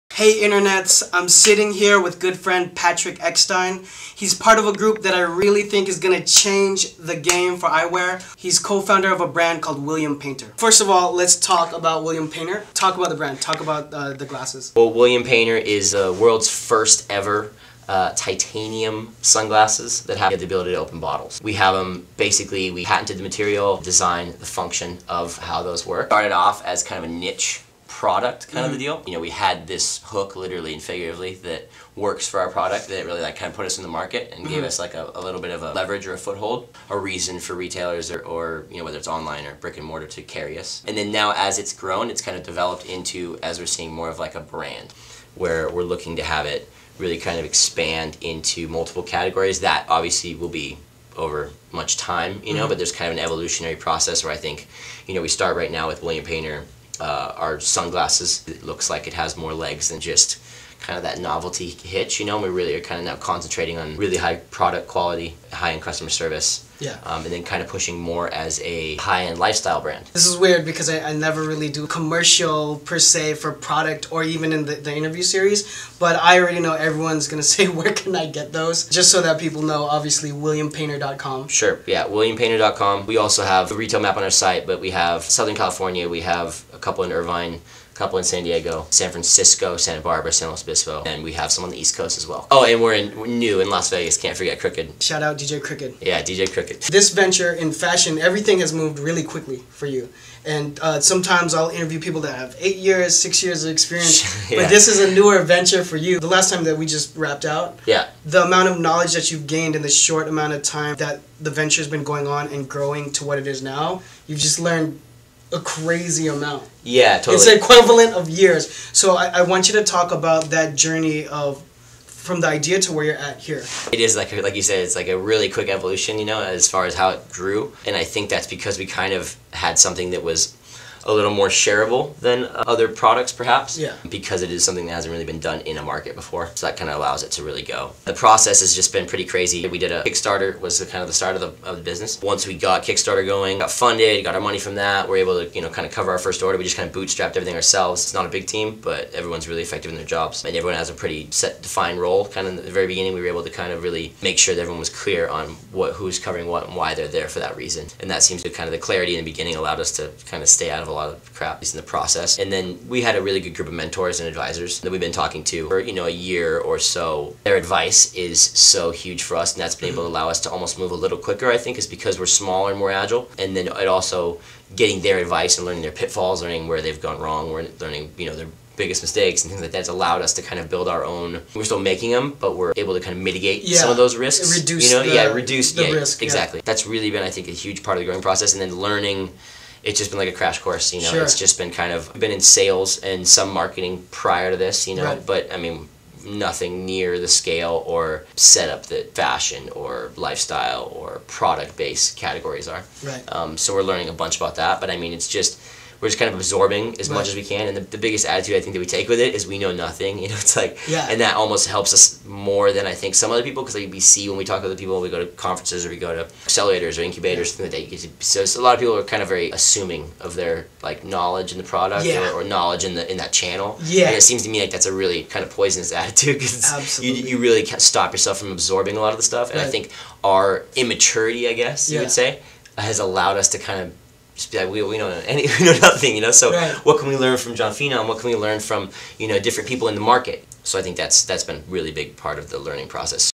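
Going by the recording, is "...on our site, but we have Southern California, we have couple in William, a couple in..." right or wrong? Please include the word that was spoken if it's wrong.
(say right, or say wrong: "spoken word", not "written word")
wrong: "Irvine", not "William".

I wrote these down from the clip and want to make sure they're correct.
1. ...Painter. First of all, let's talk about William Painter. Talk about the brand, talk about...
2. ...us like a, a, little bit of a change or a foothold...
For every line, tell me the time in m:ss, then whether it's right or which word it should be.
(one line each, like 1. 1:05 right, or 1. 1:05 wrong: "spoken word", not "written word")
1. 0:10 right
2. 0:34 wrong: "leverage", not "change".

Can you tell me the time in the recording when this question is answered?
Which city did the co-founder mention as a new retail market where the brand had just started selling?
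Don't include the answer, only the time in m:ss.
1:33.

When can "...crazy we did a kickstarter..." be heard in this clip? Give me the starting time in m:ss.
2:19.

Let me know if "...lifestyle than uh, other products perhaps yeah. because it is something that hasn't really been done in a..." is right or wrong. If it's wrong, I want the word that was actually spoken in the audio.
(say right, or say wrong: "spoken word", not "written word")
wrong: "shareable", not "lifestyle".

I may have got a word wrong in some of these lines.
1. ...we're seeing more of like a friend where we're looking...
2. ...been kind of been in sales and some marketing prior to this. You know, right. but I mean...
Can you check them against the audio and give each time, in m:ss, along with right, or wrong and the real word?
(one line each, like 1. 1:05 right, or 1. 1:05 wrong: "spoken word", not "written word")
1. 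0:43 wrong: "brand", not "friend"
2. 3:11 right.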